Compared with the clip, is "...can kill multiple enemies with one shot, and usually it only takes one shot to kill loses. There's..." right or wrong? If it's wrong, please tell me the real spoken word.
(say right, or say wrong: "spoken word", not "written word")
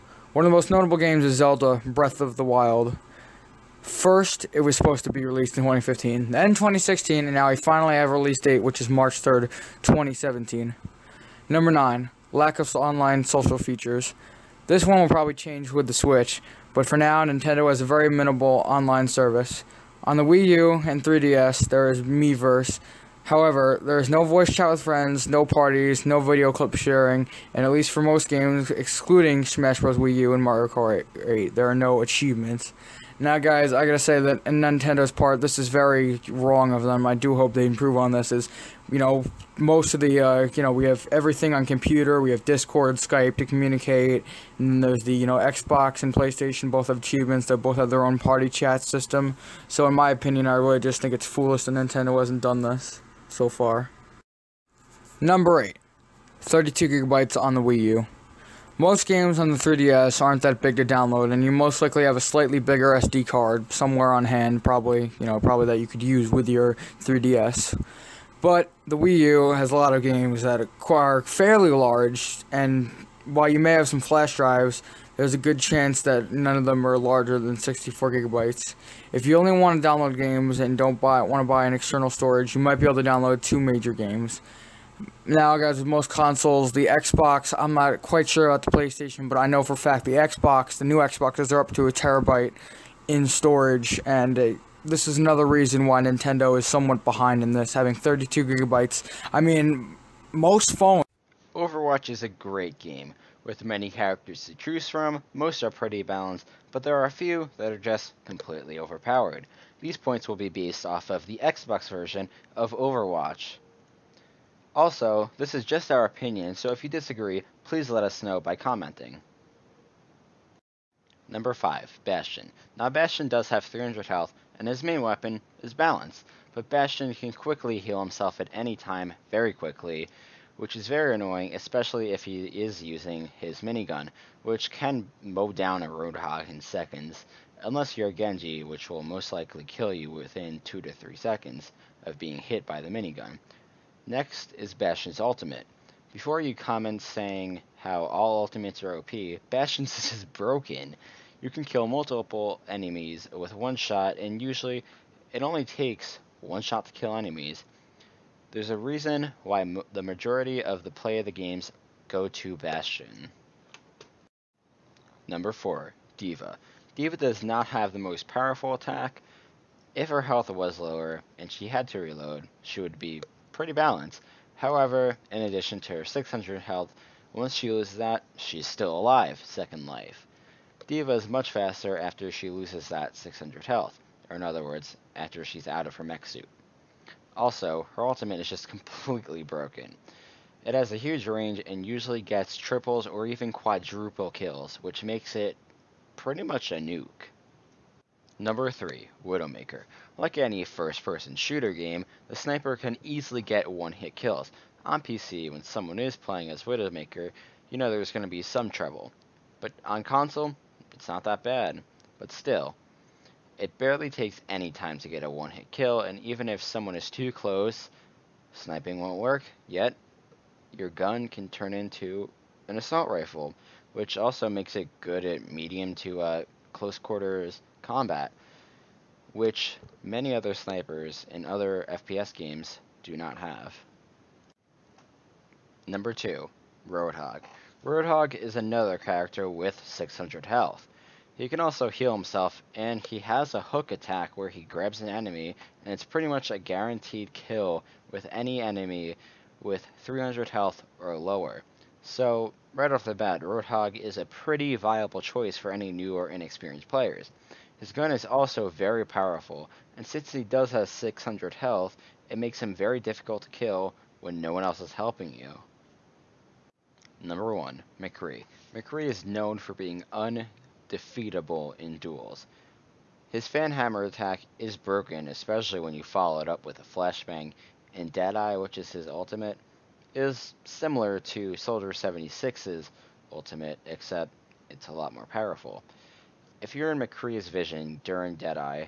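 wrong: "enemies", not "loses".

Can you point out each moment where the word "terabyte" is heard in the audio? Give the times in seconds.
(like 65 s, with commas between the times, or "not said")
91 s.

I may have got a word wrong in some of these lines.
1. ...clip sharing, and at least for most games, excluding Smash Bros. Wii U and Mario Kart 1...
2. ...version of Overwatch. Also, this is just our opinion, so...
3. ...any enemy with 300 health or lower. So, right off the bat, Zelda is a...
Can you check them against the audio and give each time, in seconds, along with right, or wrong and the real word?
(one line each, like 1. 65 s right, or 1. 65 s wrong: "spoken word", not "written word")
1. 26 s wrong: "8", not "1"
2. 111 s right
3. 248 s wrong: "Roadhog", not "Zelda".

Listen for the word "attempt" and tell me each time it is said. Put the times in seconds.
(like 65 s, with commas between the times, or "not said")
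not said.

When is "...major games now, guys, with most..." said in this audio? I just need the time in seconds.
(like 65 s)
83 s.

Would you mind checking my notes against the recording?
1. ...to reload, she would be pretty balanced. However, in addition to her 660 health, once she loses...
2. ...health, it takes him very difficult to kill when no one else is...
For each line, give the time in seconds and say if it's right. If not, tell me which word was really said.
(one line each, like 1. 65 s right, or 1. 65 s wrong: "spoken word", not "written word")
1. 171 s wrong: "600", not "660"
2. 261 s wrong: "makes", not "takes".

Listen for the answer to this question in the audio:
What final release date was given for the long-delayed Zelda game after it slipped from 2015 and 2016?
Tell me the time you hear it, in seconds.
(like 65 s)
8 s.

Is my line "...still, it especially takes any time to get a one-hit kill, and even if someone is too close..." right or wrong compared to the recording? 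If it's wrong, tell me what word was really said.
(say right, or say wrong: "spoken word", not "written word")
wrong: "barely", not "especially".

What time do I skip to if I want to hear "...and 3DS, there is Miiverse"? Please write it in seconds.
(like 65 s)
20 s.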